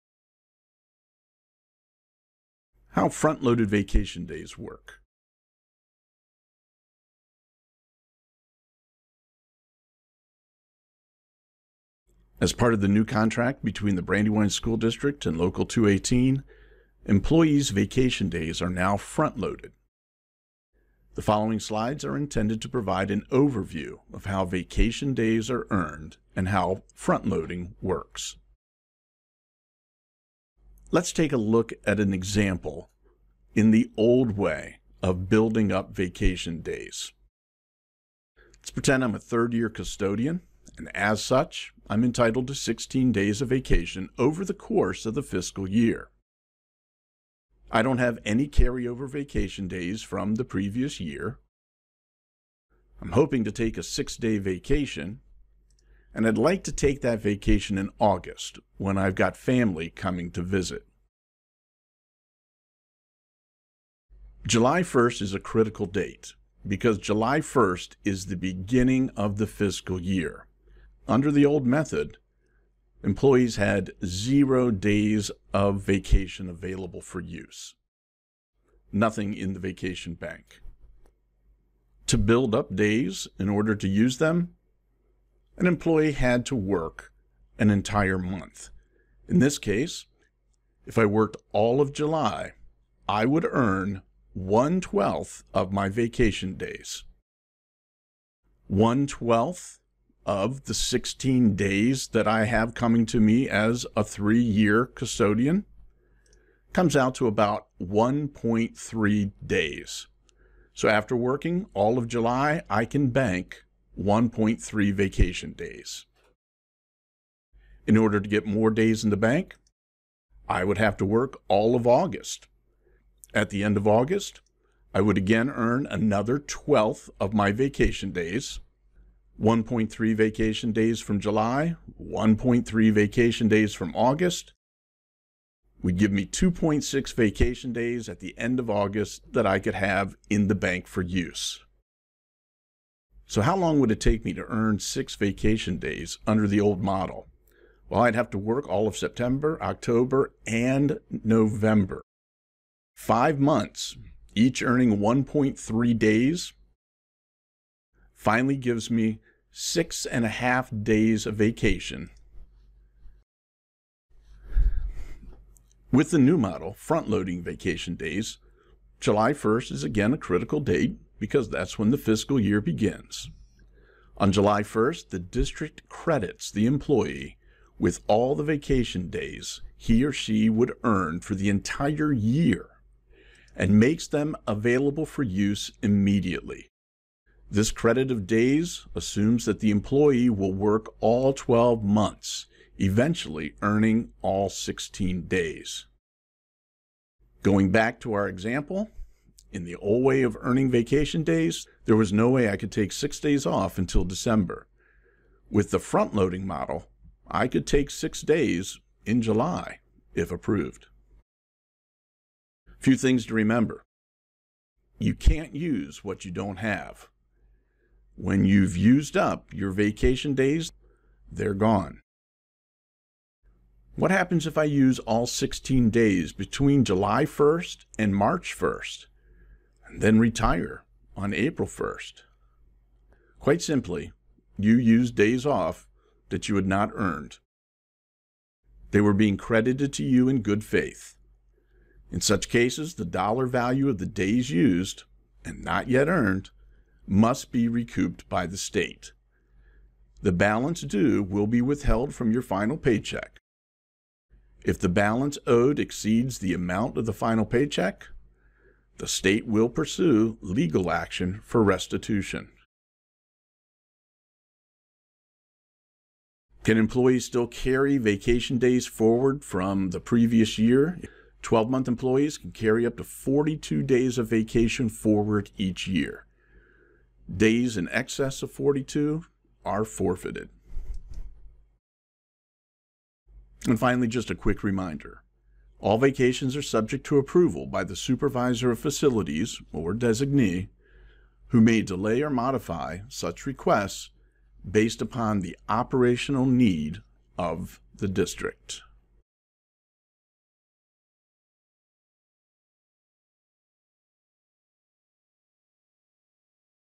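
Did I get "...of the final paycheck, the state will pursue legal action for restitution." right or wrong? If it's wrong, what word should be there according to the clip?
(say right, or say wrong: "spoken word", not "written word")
right.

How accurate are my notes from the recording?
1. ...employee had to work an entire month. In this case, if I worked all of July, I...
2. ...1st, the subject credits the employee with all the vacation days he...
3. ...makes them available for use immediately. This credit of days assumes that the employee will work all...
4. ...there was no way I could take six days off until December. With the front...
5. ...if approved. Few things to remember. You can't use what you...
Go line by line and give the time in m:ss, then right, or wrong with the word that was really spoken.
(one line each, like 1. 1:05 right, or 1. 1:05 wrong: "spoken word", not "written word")
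1. 1:25 right
2. 2:54 wrong: "district", not "subject"
3. 3:03 right
4. 3:21 right
5. 3:30 right.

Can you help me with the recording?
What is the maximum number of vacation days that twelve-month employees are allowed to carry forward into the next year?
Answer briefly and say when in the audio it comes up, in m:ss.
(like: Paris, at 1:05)
42, at 4:33.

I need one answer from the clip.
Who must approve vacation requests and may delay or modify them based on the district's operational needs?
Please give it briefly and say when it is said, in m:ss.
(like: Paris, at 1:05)
supervisor of facilities, at 4:47.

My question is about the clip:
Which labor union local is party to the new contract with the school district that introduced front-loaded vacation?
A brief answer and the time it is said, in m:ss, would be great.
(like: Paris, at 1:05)
Local 218, at 0:15.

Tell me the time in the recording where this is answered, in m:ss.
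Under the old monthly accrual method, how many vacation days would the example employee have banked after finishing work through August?
2:16.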